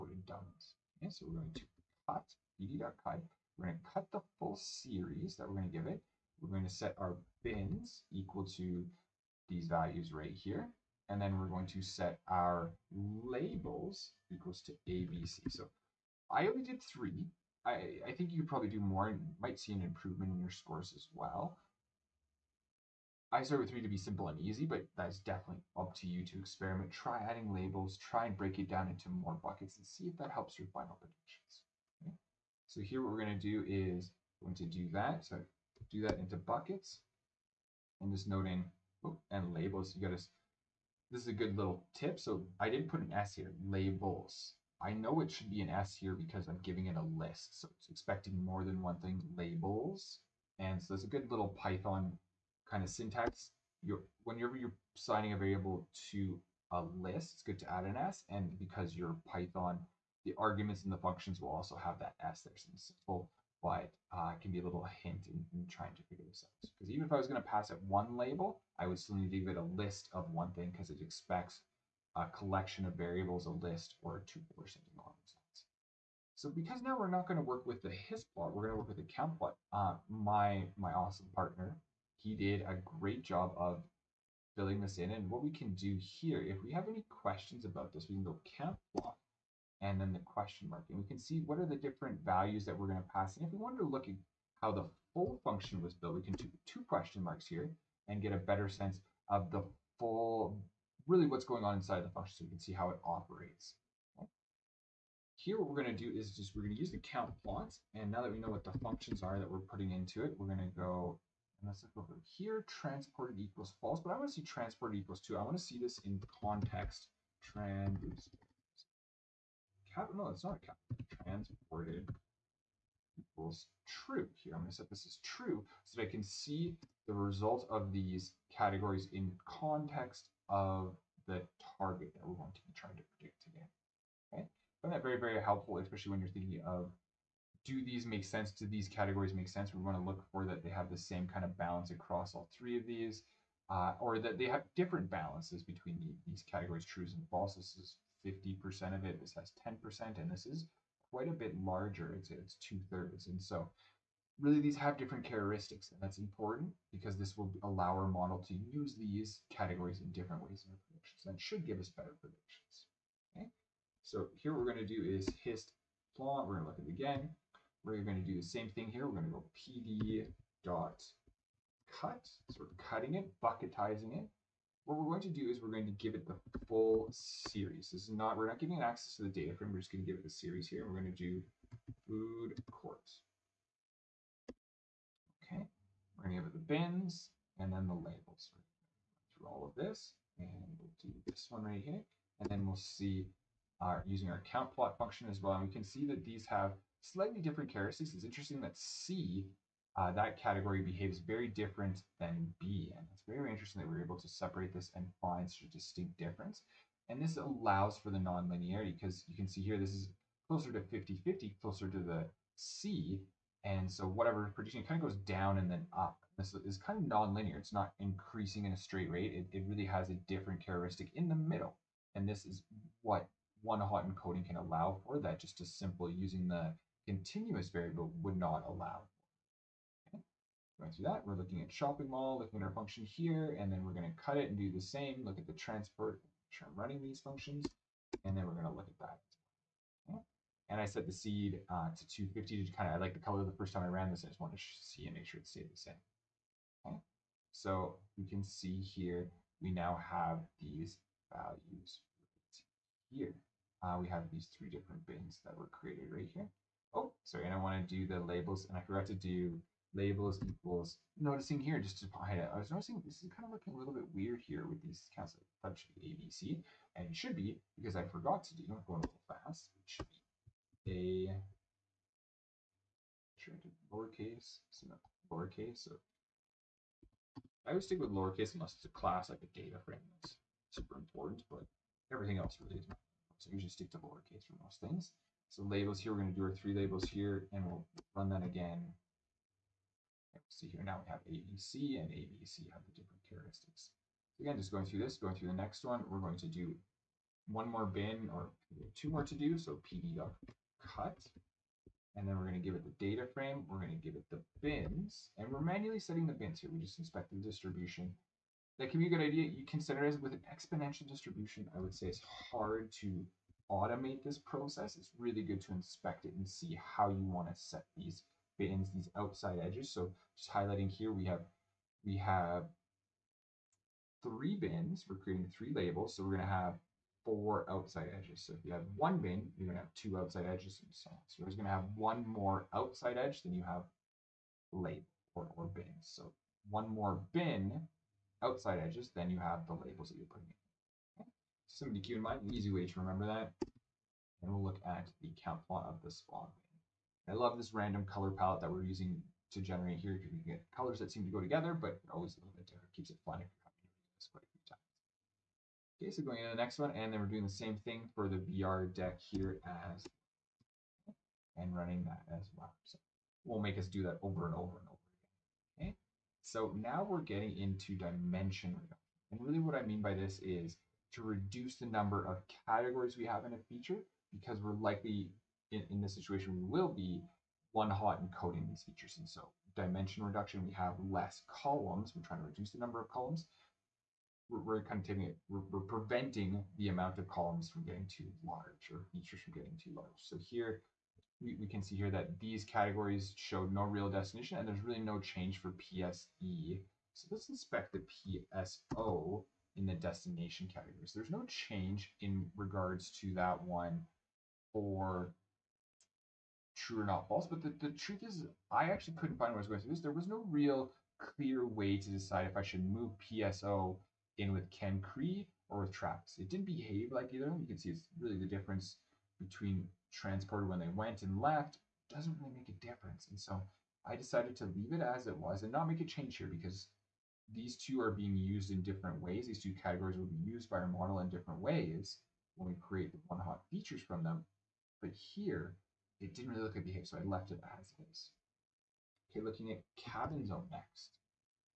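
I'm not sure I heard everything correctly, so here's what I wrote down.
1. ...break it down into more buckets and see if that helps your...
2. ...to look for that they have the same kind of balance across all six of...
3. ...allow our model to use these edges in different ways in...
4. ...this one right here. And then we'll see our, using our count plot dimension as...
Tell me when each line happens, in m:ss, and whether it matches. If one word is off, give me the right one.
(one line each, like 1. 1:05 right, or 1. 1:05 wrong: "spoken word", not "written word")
1. 0:28 right
2. 2:19 wrong: "three", not "six"
3. 2:37 wrong: "categories", not "edges"
4. 3:11 wrong: "function", not "dimension".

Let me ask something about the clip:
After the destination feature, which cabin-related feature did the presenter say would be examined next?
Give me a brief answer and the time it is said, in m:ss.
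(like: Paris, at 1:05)
cabin zone, at 7:19.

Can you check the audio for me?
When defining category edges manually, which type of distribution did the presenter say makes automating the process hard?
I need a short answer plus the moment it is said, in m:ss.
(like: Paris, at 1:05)
exponential distribution, at 5:10.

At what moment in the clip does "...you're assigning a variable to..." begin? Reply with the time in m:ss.
0:54.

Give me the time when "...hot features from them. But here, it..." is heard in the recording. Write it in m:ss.
7:13.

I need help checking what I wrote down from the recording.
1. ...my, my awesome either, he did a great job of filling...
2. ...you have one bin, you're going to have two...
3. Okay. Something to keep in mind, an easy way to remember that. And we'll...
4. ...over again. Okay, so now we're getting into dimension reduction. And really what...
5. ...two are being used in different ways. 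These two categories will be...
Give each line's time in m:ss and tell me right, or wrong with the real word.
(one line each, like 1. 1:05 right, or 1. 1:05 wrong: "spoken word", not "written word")
1. 1:20 wrong: "partner", not "either"
2. 5:28 right
3. 5:41 right
4. 6:04 right
5. 7:07 right.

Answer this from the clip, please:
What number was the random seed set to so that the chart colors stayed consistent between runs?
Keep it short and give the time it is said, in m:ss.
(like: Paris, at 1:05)
250, at 4:02.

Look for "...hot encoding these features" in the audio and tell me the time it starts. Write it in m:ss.
6:17.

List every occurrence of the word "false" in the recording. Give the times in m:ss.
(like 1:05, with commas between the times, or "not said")
1:53, 2:27, 6:47.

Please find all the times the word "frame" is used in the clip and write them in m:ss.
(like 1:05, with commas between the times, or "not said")
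2:59, 4:39, 5:03.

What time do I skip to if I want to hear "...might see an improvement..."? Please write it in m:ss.
0:19.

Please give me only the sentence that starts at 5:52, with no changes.
Keeps it fun if you're coming this quite a few times.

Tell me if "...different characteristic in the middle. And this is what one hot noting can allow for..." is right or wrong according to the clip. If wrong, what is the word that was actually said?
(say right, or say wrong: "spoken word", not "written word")
wrong: "encoding", not "noting".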